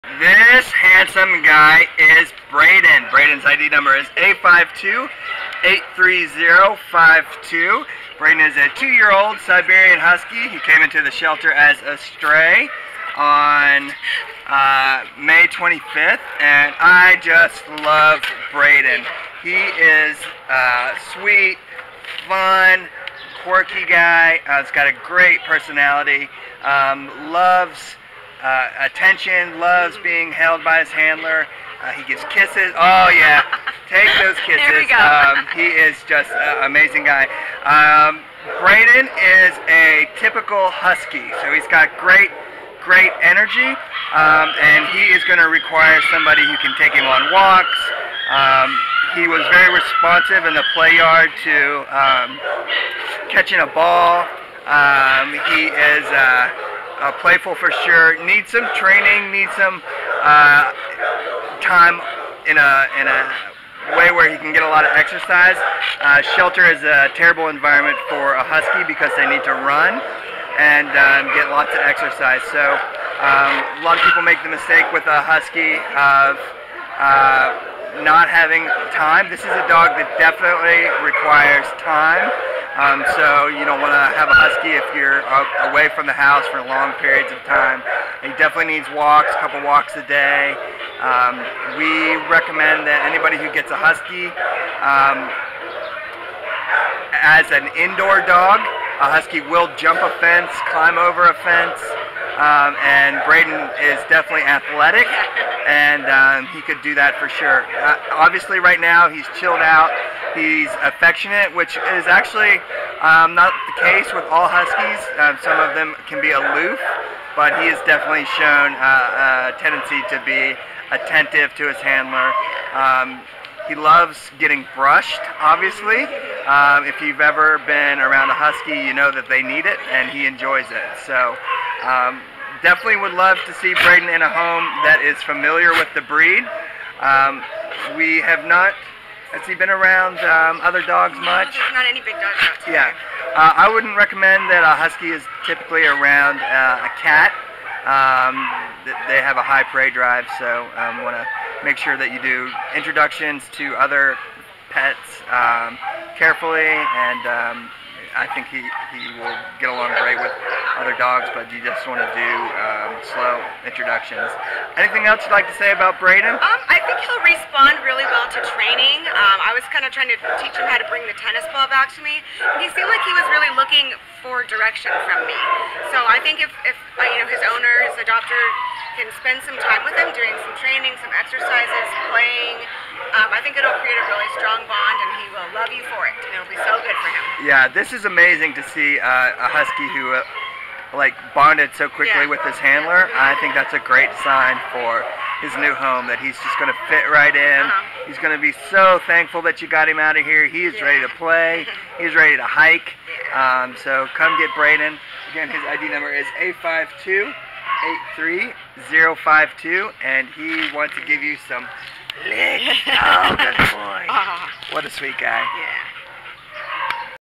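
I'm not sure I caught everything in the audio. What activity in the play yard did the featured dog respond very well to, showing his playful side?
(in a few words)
Catching a ball.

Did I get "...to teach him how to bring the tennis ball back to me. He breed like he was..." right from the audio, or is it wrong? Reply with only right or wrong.
wrong.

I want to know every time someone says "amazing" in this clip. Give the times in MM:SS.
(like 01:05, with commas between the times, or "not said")
00:36, 03:08.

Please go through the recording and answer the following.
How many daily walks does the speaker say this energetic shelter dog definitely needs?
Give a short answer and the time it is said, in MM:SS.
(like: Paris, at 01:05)
A couple, at 01:29.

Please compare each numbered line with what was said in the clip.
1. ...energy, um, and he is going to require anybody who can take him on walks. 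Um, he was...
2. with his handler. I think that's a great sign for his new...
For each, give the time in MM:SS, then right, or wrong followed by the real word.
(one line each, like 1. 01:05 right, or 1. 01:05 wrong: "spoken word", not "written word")
1. 00:43 wrong: "somebody", not "anybody"
2. 03:12 right.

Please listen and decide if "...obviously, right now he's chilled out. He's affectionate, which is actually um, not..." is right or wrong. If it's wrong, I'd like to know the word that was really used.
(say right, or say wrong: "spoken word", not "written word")
right.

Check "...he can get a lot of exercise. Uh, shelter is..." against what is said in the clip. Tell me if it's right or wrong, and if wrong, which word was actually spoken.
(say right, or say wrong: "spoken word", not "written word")
right.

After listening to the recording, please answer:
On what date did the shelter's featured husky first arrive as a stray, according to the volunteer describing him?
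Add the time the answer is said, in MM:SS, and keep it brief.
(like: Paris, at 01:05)
May 25th, at 00:15.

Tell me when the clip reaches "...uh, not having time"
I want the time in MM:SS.
01:17.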